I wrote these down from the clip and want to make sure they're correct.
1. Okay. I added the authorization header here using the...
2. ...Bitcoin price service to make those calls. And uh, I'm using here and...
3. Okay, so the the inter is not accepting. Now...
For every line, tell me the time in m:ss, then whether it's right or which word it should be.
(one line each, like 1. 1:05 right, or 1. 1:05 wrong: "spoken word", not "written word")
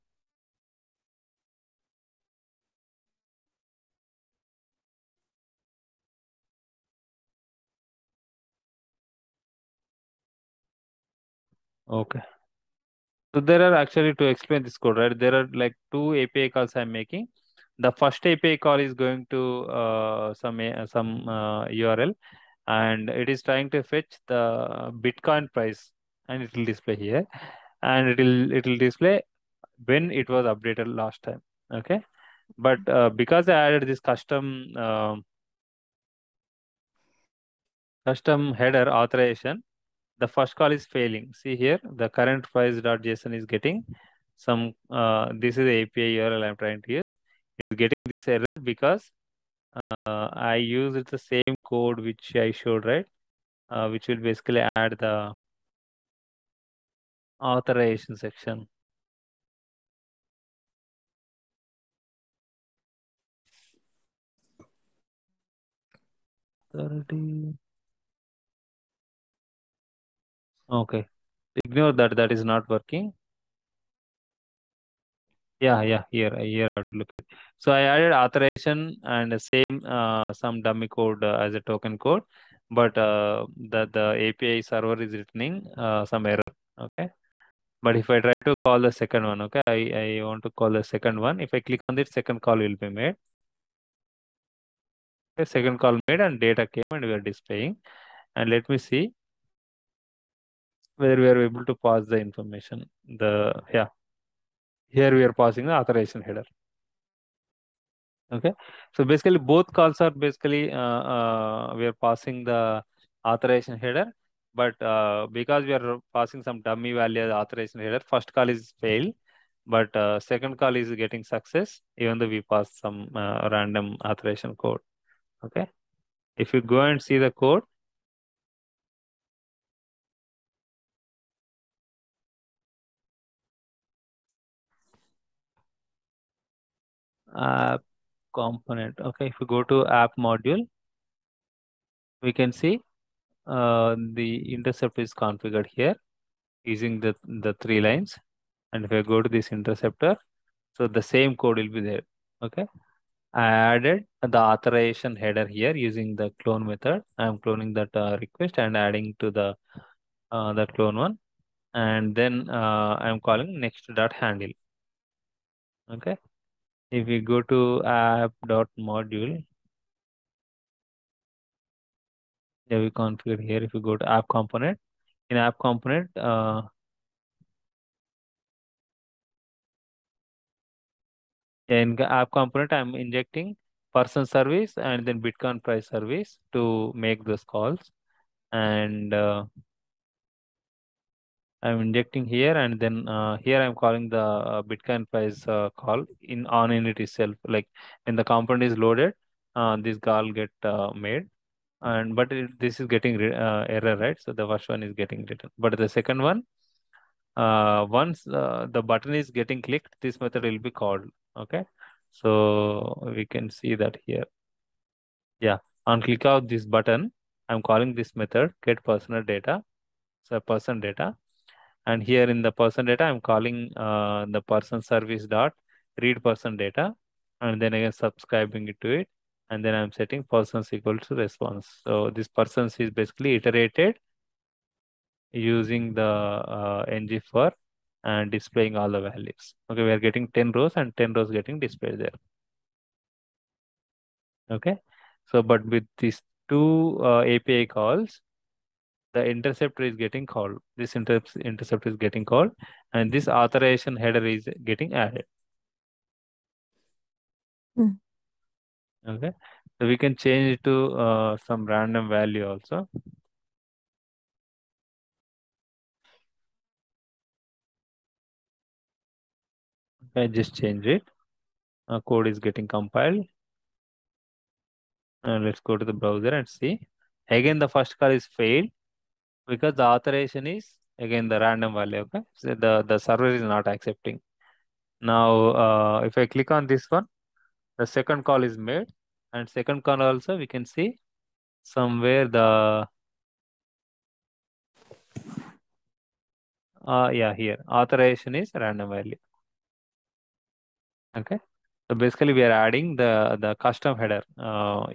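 1. 2:32 right
2. 3:05 wrong: "injecting", not "using"
3. 4:42 wrong: "server", not "inter".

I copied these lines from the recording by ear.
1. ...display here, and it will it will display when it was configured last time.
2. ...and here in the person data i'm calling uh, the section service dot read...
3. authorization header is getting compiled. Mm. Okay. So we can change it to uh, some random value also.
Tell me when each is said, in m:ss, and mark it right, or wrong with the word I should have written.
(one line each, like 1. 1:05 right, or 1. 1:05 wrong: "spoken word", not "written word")
1. 0:26 wrong: "updated", not "configured"
2. 3:41 wrong: "person", not "section"
3. 4:13 wrong: "added", not "compiled".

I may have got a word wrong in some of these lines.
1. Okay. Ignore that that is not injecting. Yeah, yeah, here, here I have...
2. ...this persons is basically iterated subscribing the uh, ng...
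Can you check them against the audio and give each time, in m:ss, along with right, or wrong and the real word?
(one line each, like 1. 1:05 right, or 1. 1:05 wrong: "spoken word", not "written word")
1. 1:10 wrong: "working", not "injecting"
2. 3:52 wrong: "using", not "subscribing".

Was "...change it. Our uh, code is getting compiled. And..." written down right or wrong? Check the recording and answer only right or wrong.
right.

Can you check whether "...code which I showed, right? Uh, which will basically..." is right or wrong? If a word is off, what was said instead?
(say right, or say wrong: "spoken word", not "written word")
right.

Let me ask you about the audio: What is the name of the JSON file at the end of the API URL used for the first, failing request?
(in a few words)
current price.json.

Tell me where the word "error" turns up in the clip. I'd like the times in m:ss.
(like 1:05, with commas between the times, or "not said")
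0:48, 1:26, 3:23.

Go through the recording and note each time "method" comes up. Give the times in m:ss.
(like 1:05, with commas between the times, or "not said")
2:36, 3:30, 3:38.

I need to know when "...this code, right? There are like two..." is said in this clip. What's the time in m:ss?
0:14.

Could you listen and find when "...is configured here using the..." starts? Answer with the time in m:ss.
2:24.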